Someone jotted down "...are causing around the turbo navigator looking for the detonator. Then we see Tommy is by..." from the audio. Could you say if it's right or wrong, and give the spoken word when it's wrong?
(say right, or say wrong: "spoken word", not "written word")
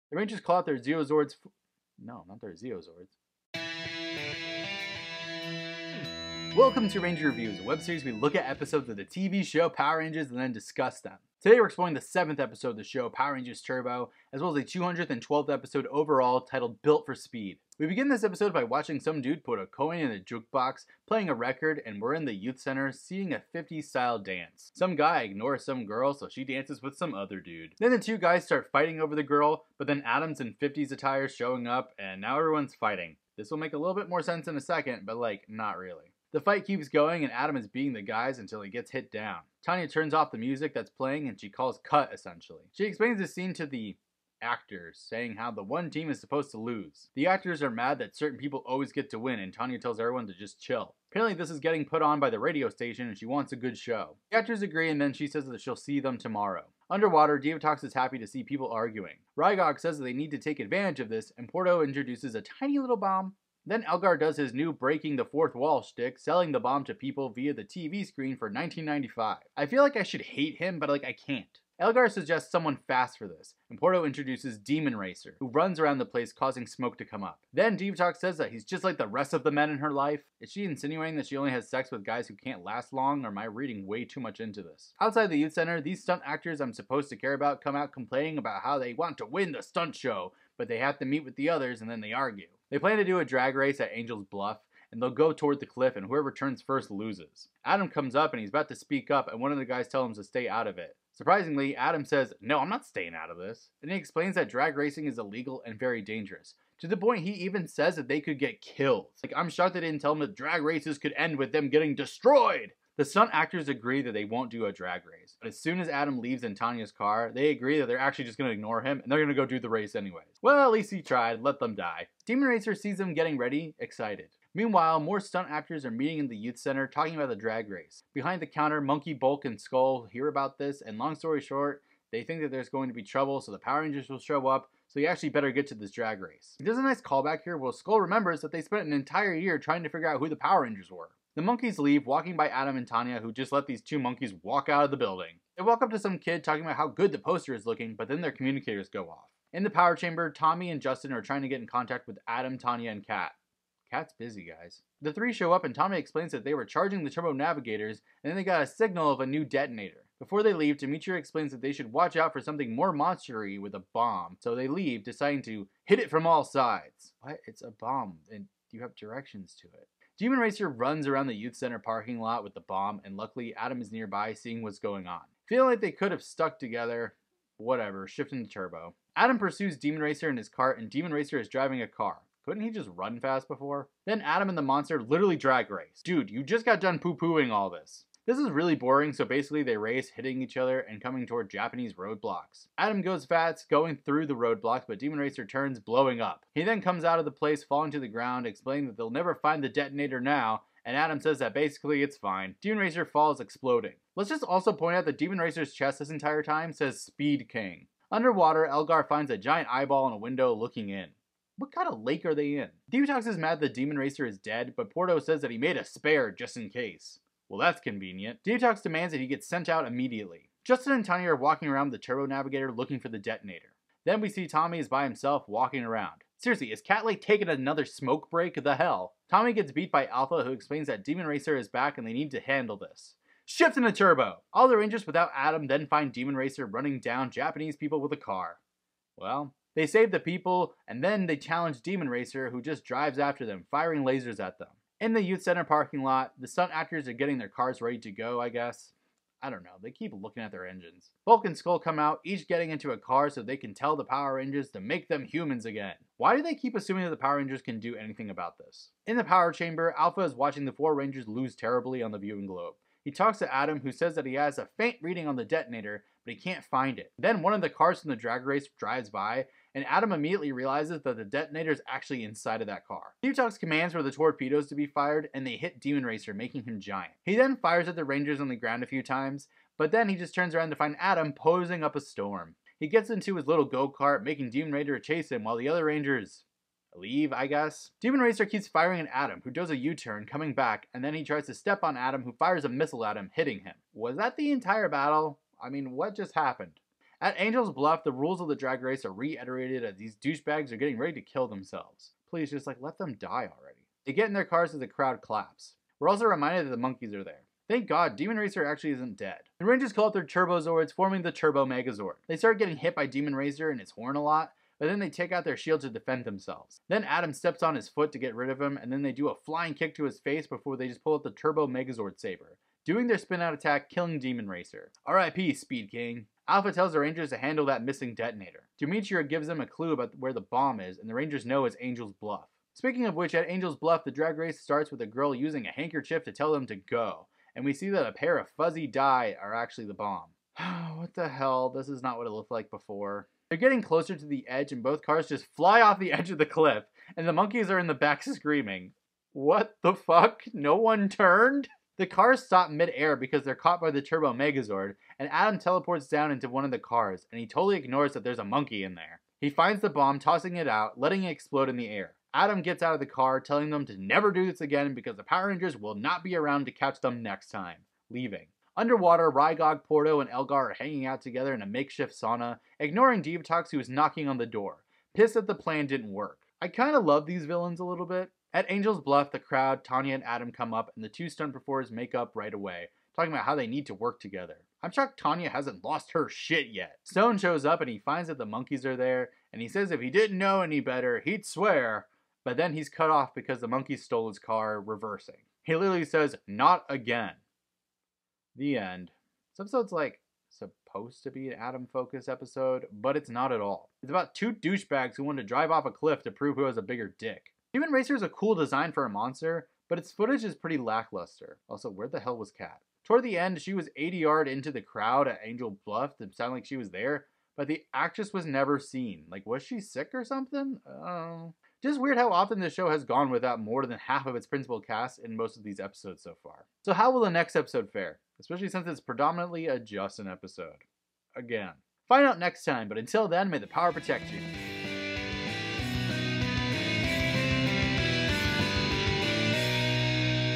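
wrong: "walking", not "causing".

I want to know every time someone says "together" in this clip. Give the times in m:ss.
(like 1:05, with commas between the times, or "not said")
2:56, 6:11, 6:24.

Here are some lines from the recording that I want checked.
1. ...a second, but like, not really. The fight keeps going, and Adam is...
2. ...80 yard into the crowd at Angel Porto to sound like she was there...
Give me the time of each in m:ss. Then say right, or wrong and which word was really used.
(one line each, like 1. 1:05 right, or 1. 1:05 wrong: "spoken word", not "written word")
1. 0:34 right
2. 6:53 wrong: "Bluff", not "Porto".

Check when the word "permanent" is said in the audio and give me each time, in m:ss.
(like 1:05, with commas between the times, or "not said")
not said.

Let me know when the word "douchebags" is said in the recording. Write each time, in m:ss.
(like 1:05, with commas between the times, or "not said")
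5:00, 6:44.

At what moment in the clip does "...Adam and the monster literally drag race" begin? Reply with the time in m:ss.
3:04.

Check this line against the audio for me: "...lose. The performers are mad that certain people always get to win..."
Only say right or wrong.
wrong.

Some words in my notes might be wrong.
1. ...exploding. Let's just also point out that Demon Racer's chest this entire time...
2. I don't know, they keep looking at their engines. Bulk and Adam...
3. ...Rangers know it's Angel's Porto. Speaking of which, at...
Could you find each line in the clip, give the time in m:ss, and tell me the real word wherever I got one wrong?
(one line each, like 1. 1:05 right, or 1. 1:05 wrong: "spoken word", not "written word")
1. 3:23 right
2. 4:09 wrong: "Skull", not "Adam"
3. 5:31 wrong: "Bluff", not "Porto".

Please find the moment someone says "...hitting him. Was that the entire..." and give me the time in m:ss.
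4:53.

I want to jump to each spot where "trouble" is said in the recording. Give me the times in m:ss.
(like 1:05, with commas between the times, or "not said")
2:13.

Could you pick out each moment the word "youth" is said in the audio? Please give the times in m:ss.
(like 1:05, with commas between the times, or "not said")
0:22, 1:25, 2:06, 2:51, 4:05.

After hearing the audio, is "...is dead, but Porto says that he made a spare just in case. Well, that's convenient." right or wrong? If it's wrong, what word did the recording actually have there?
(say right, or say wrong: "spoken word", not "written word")
right.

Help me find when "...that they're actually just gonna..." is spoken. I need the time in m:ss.
1:57.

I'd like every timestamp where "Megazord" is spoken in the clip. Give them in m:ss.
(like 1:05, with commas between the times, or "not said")
5:11, 5:21, 5:54.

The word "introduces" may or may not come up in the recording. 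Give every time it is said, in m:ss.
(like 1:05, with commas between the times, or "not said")
1:01, 1:14.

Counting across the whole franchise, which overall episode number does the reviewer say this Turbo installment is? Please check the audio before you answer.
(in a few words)
212th.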